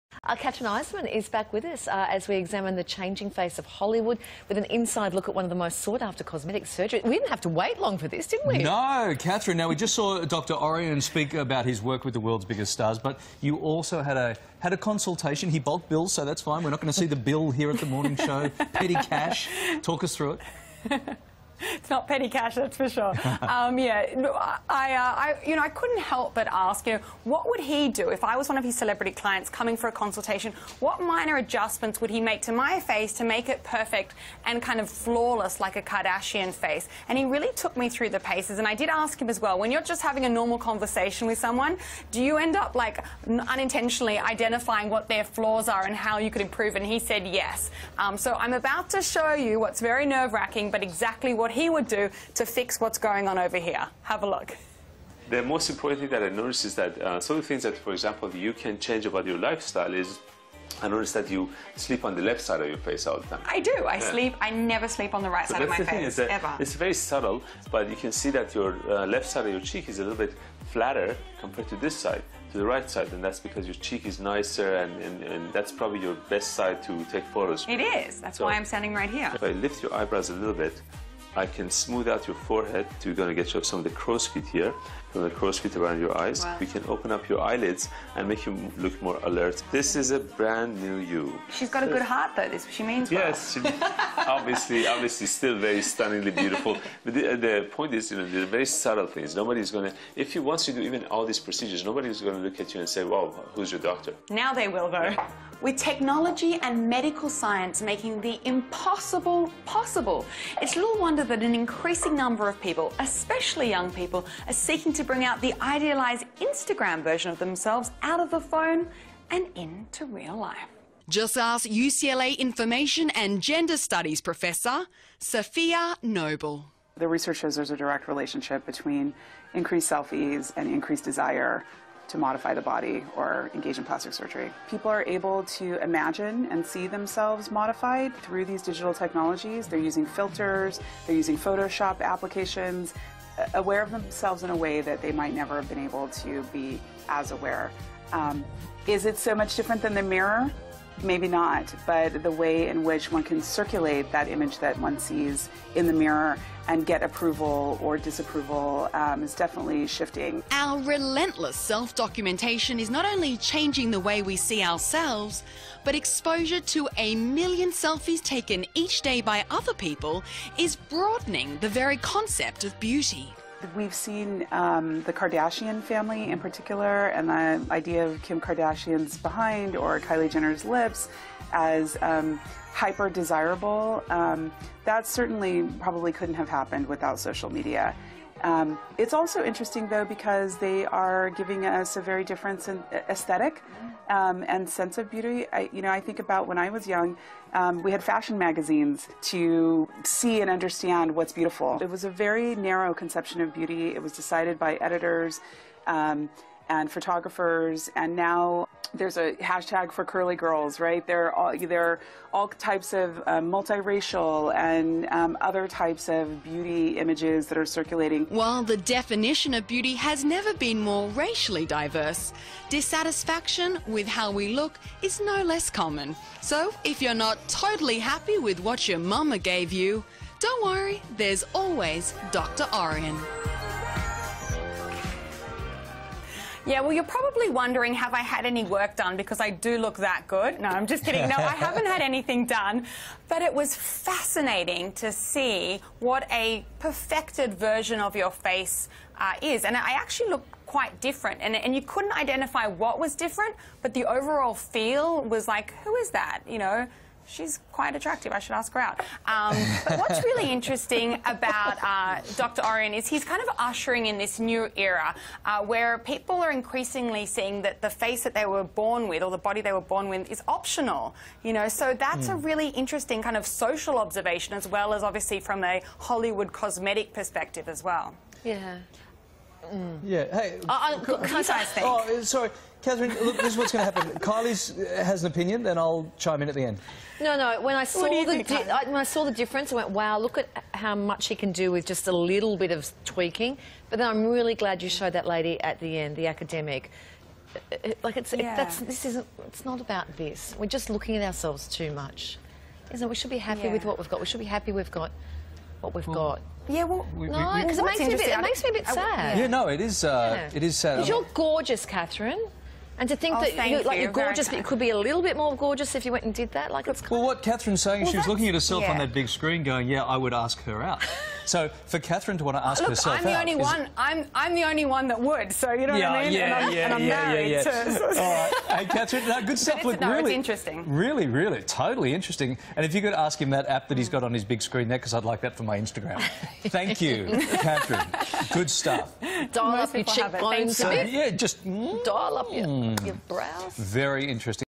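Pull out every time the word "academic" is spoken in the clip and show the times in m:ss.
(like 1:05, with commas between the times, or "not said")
4:56.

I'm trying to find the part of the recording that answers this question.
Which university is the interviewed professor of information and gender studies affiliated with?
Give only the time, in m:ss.
2:01.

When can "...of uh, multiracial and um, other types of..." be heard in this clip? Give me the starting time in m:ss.
3:32.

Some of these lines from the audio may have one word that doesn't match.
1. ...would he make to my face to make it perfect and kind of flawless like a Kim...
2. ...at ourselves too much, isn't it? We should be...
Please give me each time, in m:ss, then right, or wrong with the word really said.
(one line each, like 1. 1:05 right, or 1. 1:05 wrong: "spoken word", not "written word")
1. 0:32 wrong: "Kardashian", not "Kim"
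2. 5:01 right.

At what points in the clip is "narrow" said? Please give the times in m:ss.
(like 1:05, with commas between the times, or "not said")
3:22.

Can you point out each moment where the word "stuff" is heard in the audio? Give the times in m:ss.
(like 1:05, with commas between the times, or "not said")
5:29, 5:38.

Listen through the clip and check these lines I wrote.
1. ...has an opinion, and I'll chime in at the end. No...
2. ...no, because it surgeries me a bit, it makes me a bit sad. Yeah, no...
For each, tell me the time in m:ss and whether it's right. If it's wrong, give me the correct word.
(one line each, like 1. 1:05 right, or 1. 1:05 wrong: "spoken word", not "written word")
1. 4:45 right
2. 5:07 wrong: "makes", not "surgeries".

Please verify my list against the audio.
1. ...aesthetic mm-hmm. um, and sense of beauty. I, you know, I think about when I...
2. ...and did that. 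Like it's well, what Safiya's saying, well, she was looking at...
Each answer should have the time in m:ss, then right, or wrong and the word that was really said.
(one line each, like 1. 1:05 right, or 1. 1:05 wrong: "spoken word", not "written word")
1. 3:13 right
2. 5:16 wrong: "Kathryn", not "Safiya".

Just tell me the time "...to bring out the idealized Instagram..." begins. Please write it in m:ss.
1:54.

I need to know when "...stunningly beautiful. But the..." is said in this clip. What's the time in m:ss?
1:35.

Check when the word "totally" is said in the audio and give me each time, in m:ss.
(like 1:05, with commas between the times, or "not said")
3:47, 5:31.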